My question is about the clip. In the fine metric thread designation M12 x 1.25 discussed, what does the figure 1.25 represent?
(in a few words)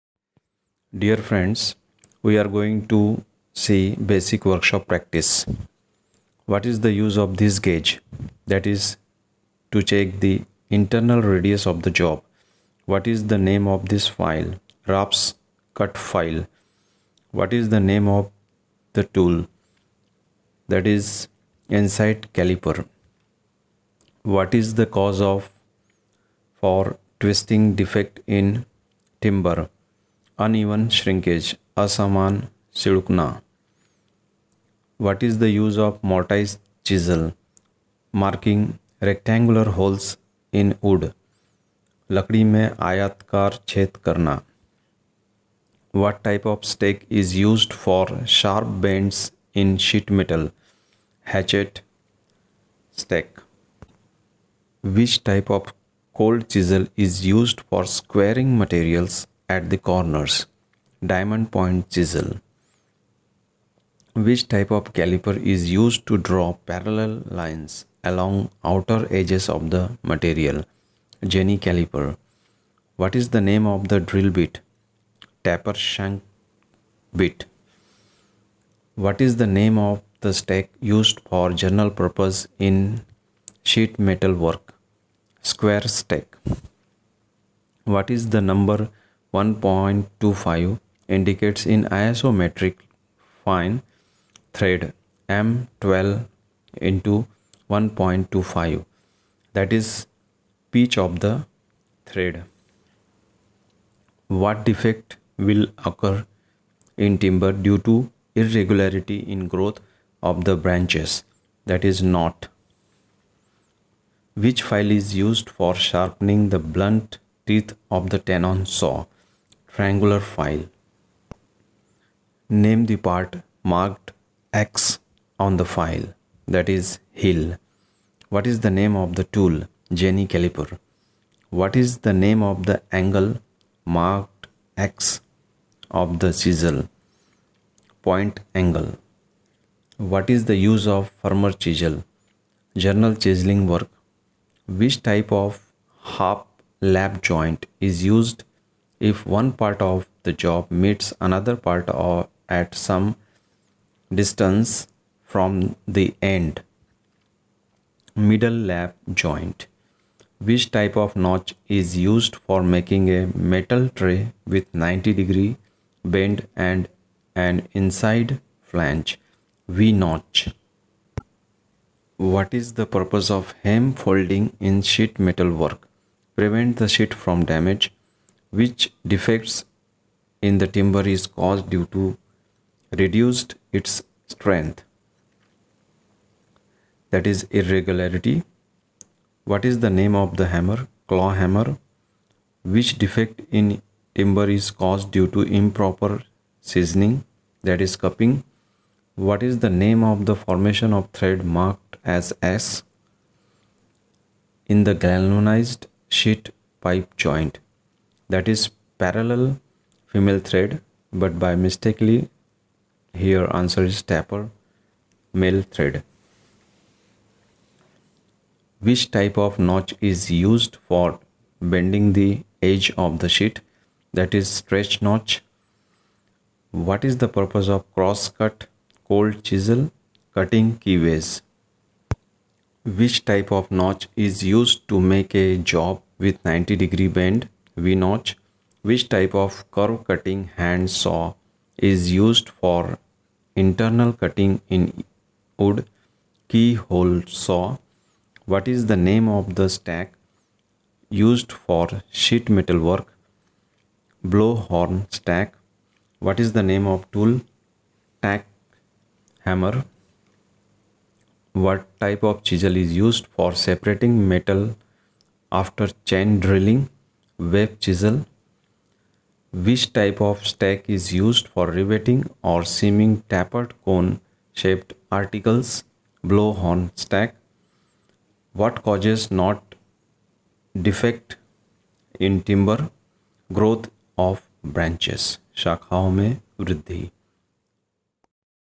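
Pitch of the thread.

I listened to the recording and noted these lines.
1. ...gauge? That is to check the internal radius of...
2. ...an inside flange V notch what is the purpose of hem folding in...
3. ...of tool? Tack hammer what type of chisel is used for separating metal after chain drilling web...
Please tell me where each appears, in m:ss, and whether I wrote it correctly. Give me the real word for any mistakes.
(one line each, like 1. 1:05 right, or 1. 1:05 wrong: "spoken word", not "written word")
1. 0:07 right
2. 2:47 right
3. 4:16 right.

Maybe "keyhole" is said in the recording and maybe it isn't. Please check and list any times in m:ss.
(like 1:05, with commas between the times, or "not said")
4:06.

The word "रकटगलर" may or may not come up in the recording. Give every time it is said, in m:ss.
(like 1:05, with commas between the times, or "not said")
0:39.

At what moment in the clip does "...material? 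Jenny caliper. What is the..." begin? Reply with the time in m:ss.
1:10.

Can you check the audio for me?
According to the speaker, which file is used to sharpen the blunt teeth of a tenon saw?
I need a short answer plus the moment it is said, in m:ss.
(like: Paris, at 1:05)
Triangular file, at 1:59.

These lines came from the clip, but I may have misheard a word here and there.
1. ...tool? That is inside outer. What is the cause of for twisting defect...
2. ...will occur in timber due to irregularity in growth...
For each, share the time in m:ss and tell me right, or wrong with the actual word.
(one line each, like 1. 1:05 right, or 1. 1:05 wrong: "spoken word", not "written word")
1. 0:19 wrong: "caliper", not "outer"
2. 1:45 right.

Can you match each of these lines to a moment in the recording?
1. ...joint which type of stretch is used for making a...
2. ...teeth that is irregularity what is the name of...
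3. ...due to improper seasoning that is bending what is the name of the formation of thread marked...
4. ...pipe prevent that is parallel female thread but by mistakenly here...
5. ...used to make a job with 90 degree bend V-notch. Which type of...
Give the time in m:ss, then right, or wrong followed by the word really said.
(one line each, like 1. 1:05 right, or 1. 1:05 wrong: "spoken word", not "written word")
1. 2:39 wrong: "notch", not "stretch"
2. 3:04 wrong: "strength", not "teeth"
3. 3:15 wrong: "cupping", not "bending"
4. 3:26 wrong: "joint", not "prevent"
5. 3:54 right.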